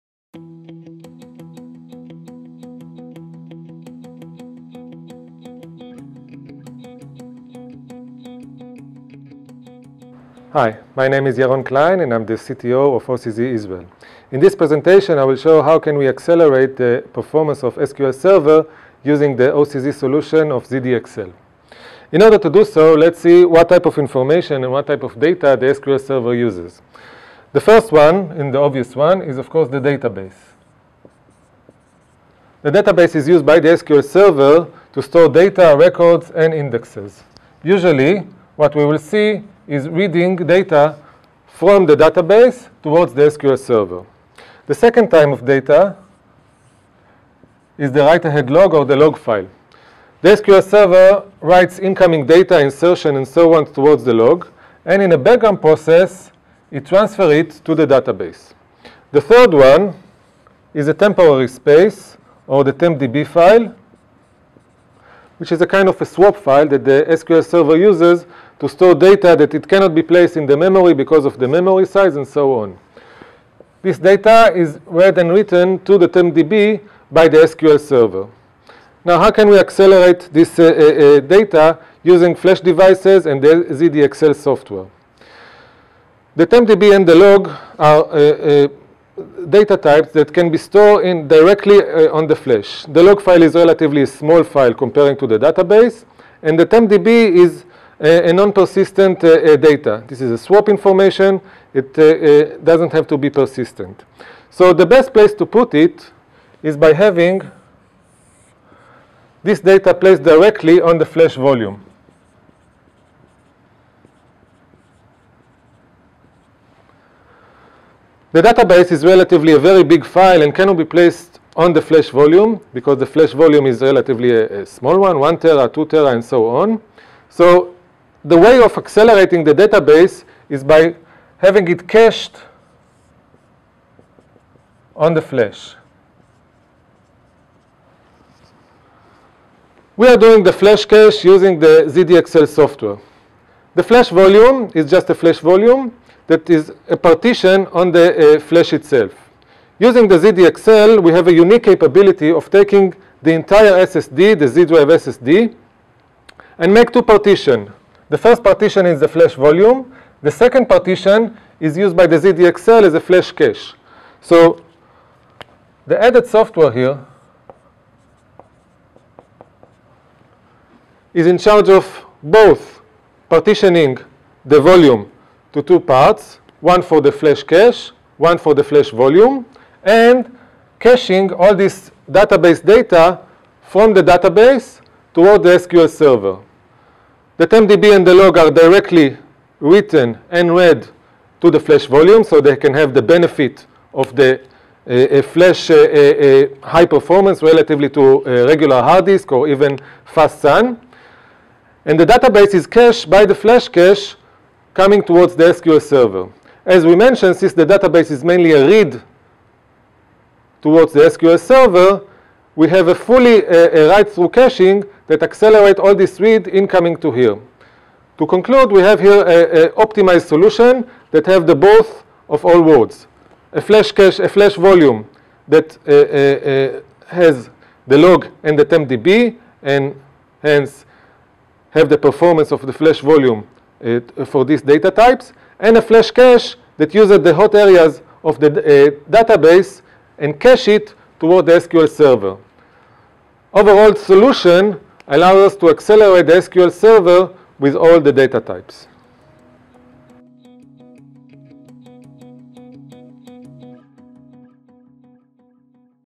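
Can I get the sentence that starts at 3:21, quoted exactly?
And the database is cached by the flash cache coming towards the SQL server.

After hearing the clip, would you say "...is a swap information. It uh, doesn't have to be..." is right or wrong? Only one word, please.
right.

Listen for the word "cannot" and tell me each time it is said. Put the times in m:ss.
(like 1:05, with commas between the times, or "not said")
1:09, 2:00.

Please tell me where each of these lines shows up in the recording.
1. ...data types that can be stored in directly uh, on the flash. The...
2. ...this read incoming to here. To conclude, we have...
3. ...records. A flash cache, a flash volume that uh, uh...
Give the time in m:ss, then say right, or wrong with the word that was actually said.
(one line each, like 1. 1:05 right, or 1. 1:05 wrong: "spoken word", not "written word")
1. 1:29 right
2. 3:35 right
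3. 3:42 wrong: "words", not "records".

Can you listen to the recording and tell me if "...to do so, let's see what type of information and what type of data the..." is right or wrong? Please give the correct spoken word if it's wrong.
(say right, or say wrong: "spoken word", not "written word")
right.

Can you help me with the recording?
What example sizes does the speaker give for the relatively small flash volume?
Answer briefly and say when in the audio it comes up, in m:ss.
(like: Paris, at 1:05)
1 tera, 2 tera, at 2:05.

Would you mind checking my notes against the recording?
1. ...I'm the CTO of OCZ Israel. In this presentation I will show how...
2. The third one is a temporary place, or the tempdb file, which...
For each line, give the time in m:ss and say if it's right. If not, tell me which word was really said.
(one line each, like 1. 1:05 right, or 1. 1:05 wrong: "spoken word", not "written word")
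1. 0:12 right
2. 0:59 wrong: "space", not "place".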